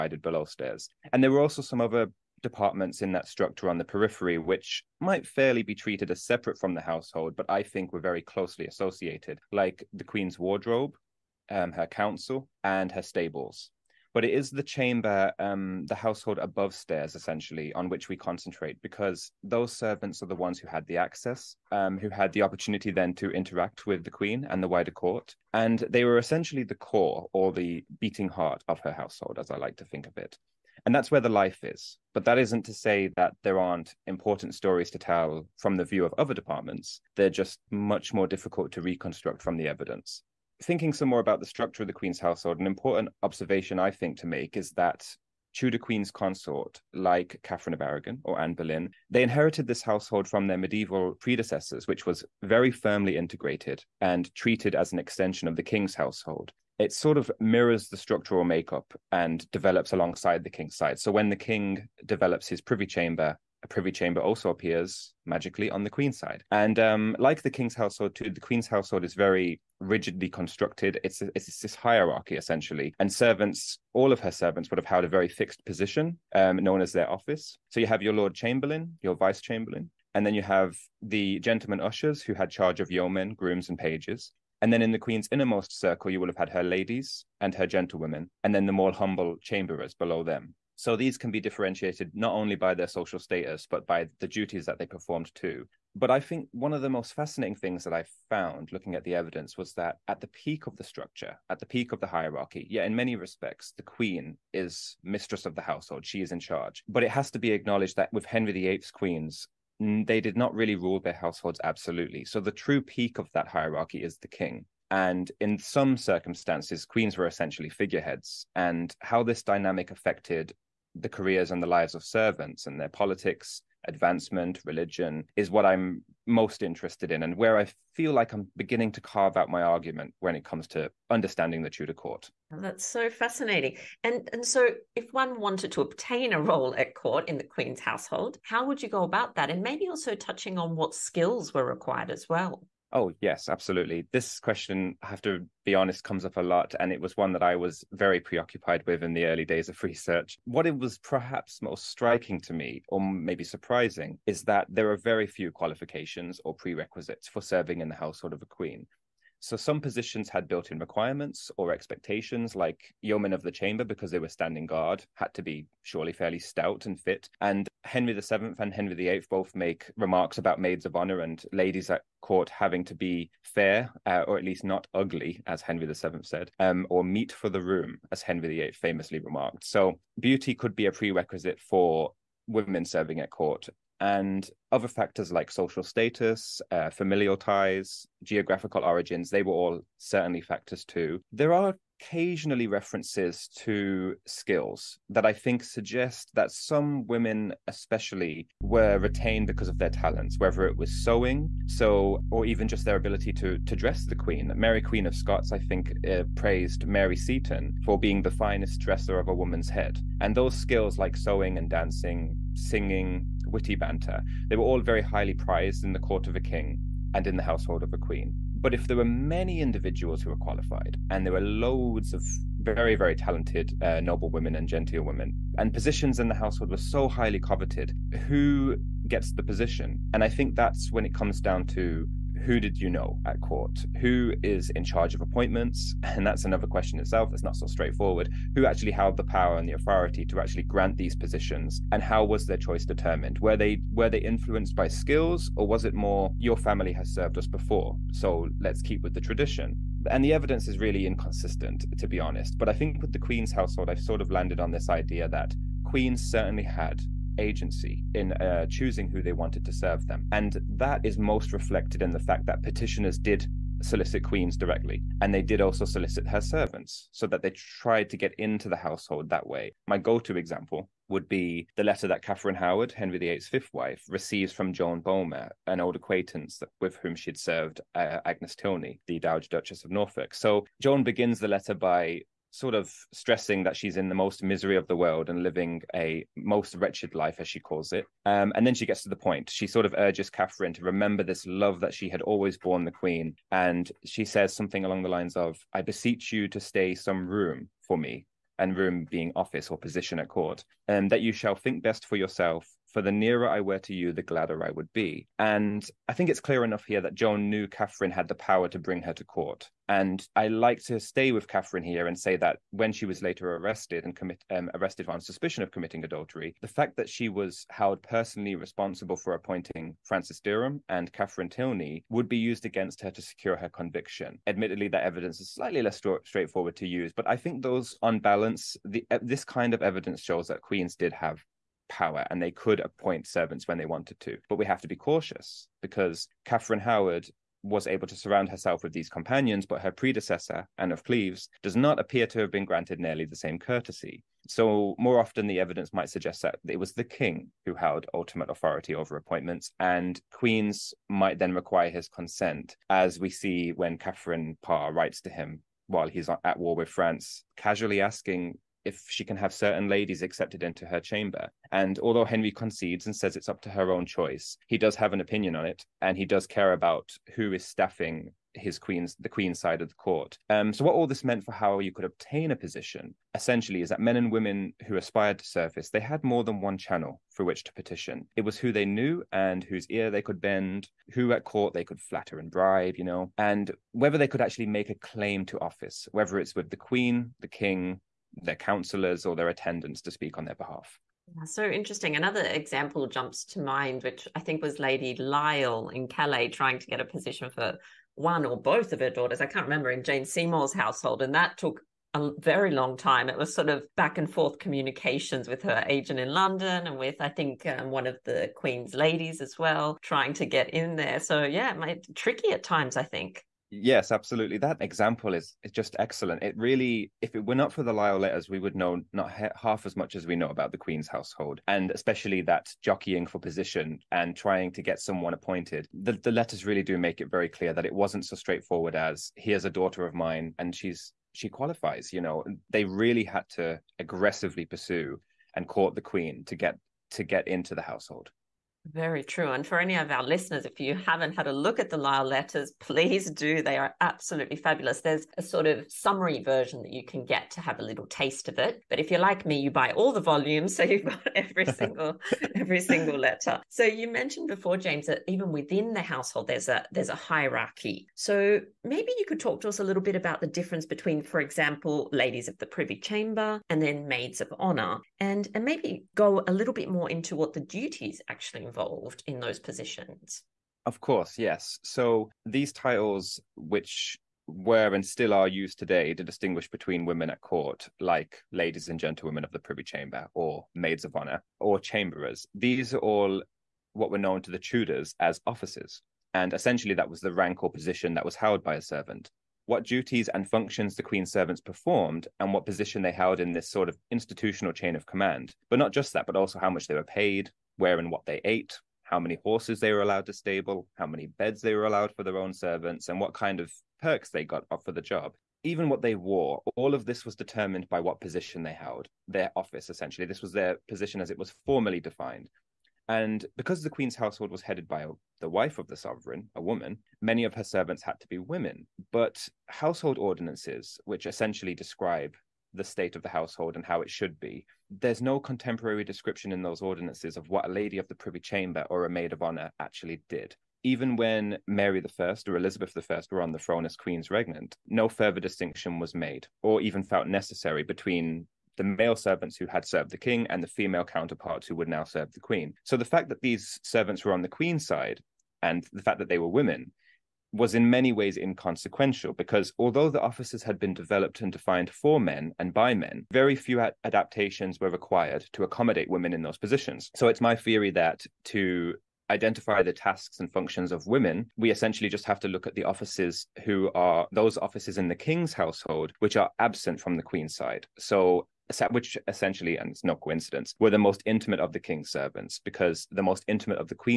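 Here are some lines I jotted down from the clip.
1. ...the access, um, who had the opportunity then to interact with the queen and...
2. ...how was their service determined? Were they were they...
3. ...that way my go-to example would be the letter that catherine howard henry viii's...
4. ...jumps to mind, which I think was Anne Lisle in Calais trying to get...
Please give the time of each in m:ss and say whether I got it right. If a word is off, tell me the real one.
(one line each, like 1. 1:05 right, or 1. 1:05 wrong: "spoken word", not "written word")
1. 0:20 right
2. 4:02 wrong: "choice", not "service"
3. 4:29 right
4. 6:33 wrong: "Lady", not "Anne".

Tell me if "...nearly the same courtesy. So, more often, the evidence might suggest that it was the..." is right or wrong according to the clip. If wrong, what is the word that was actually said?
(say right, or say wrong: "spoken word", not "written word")
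right.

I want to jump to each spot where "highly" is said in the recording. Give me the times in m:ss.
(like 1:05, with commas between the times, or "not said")
3:35, 3:47.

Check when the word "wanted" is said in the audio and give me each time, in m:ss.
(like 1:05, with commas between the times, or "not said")
2:15, 4:19, 5:33.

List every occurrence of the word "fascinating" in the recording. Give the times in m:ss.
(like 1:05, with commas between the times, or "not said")
1:37, 2:13.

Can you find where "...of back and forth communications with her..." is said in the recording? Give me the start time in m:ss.
6:43.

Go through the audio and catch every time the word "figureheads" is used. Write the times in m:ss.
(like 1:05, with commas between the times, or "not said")
1:57.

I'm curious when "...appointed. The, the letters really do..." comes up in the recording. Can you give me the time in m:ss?
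7:05.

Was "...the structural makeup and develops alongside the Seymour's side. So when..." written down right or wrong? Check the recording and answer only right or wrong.
wrong.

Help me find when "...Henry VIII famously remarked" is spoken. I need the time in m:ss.
2:58.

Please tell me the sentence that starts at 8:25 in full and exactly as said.
Even what they wore, all of this was determined by what position they held, their office essentially.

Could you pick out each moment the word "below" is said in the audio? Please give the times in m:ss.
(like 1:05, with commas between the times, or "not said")
0:00, 1:29.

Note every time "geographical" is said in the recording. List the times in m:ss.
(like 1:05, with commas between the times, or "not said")
3:08.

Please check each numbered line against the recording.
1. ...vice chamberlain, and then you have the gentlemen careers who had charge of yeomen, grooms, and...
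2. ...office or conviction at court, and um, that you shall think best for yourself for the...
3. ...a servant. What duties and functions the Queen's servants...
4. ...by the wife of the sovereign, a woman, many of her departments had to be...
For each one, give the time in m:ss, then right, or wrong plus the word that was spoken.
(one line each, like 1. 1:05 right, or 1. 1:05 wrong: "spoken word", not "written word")
1. 1:19 wrong: "ushers", not "careers"
2. 4:59 wrong: "position", not "conviction"
3. 8:08 right
4. 8:34 wrong: "servants", not "departments".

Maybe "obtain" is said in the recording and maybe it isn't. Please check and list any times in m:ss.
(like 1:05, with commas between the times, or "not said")
2:15, 6:12.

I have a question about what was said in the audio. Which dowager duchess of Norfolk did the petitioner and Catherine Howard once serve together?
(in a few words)
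Agnes Tilney.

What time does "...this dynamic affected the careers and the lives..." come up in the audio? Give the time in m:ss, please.
1:59.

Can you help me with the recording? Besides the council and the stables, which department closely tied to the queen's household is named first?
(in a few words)
the Queen's wardrobe.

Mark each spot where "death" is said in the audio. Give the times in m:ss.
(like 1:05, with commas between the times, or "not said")
not said.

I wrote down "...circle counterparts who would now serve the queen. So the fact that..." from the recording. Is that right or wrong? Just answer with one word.
wrong.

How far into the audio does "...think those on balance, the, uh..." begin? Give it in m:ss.
5:27.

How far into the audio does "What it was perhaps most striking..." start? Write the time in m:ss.
2:30.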